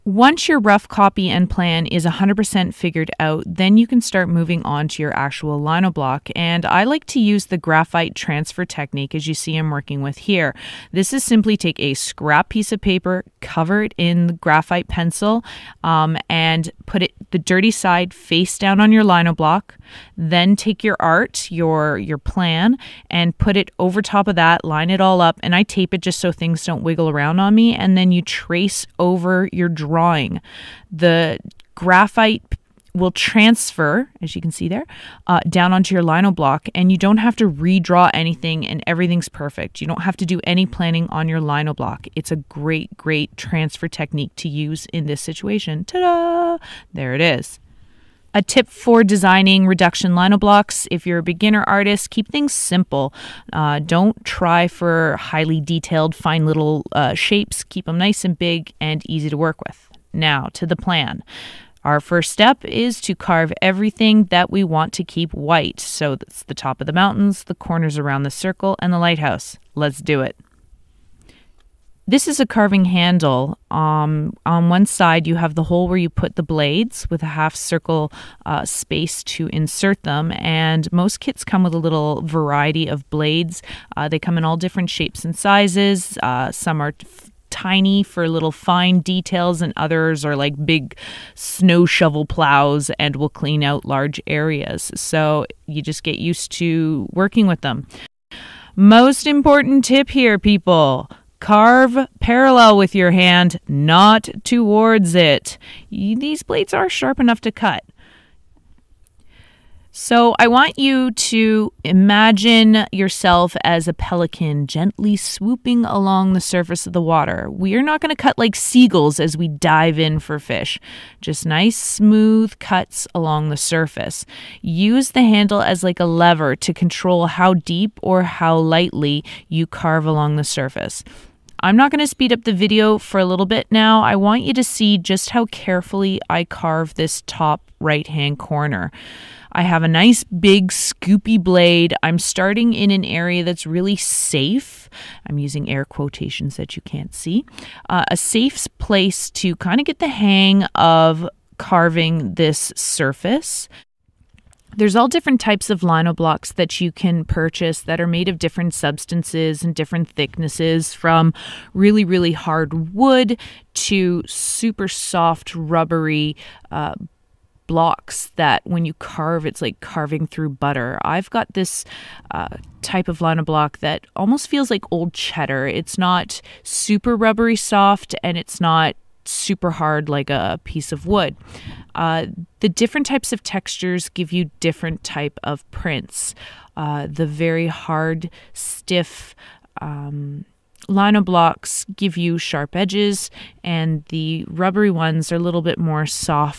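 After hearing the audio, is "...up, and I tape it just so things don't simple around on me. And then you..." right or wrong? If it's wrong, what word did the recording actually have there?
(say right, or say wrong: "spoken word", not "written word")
wrong: "wiggle", not "simple".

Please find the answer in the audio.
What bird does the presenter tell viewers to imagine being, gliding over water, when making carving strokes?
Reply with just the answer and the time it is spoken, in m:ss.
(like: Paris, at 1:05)
Pelican, at 1:53.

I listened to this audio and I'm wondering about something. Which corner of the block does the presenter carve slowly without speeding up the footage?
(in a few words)
Top right hand corner.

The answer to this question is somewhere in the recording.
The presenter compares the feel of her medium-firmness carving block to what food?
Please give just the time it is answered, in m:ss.
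2:54.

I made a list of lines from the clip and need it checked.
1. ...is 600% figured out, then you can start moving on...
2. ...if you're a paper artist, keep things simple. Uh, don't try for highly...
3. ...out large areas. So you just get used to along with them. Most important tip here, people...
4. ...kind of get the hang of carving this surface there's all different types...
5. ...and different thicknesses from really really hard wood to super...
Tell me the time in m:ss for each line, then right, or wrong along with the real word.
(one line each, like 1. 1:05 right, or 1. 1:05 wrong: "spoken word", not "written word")
1. 0:01 wrong: "100", not "600"
2. 0:50 wrong: "beginner", not "paper"
3. 1:33 wrong: "working", not "along"
4. 2:29 right
5. 2:39 right.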